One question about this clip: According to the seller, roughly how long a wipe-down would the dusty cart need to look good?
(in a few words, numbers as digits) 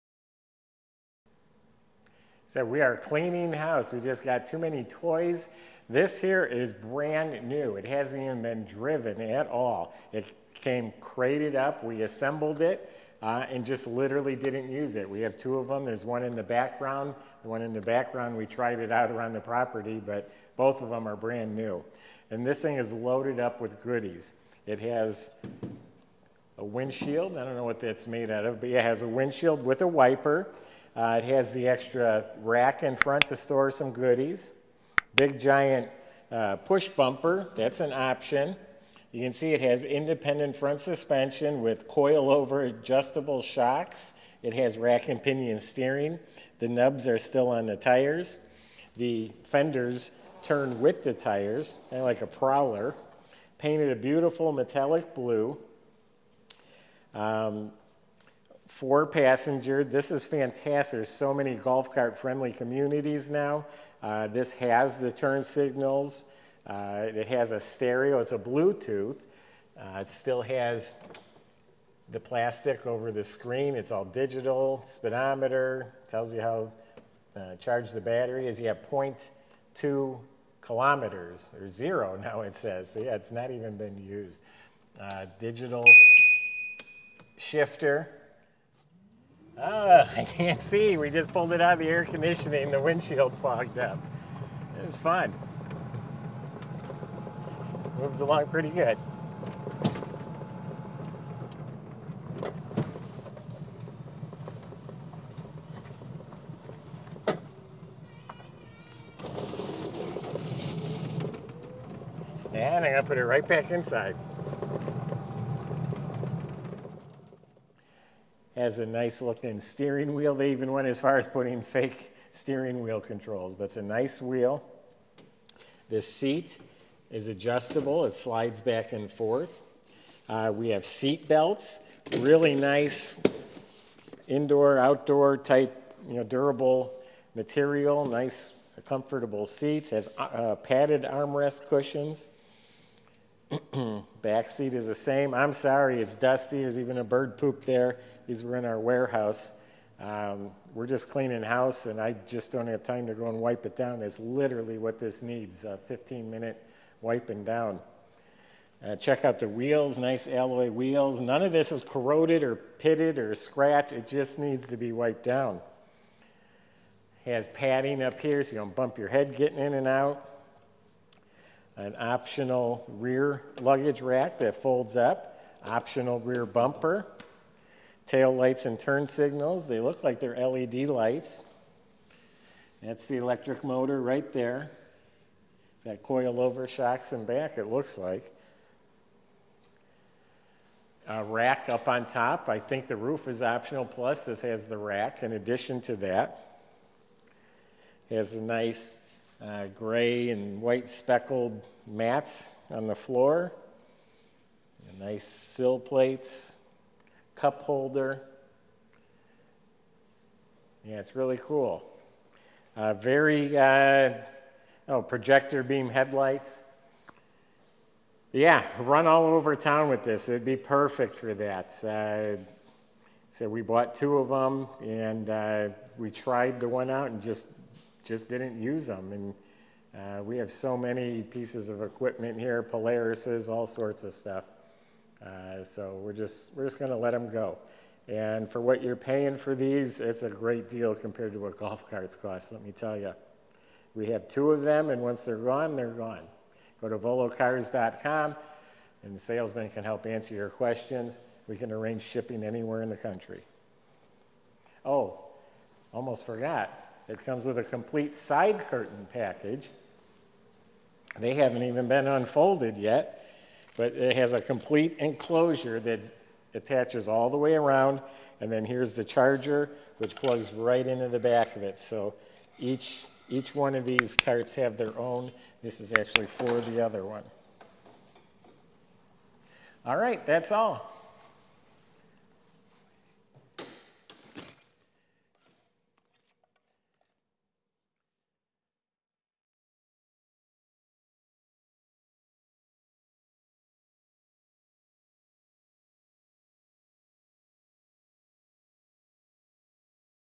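15 minutes.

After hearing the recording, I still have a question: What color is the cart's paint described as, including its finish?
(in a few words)
Metallic blue.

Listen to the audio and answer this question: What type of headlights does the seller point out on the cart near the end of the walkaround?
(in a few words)
Projector beam headlights.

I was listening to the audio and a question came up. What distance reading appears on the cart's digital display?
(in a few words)
0.2 kilometers.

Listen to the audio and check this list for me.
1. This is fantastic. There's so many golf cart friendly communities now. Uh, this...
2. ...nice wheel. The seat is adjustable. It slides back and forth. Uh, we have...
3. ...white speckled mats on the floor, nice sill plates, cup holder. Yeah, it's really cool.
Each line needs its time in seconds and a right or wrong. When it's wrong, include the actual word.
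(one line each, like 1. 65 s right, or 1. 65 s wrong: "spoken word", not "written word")
1. 59 s right
2. 123 s right
3. 200 s right.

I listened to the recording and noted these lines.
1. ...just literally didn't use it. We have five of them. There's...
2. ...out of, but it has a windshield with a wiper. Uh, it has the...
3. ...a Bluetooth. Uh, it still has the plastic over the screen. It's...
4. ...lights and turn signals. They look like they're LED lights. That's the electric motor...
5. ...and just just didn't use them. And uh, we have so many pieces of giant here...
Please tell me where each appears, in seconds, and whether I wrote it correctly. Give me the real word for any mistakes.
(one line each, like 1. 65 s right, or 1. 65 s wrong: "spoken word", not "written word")
1. 13 s wrong: "two", not "five"
2. 28 s right
3. 68 s right
4. 178 s right
5. 227 s wrong: "equipment", not "giant".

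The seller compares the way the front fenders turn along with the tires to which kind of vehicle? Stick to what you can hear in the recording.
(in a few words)
Prowler.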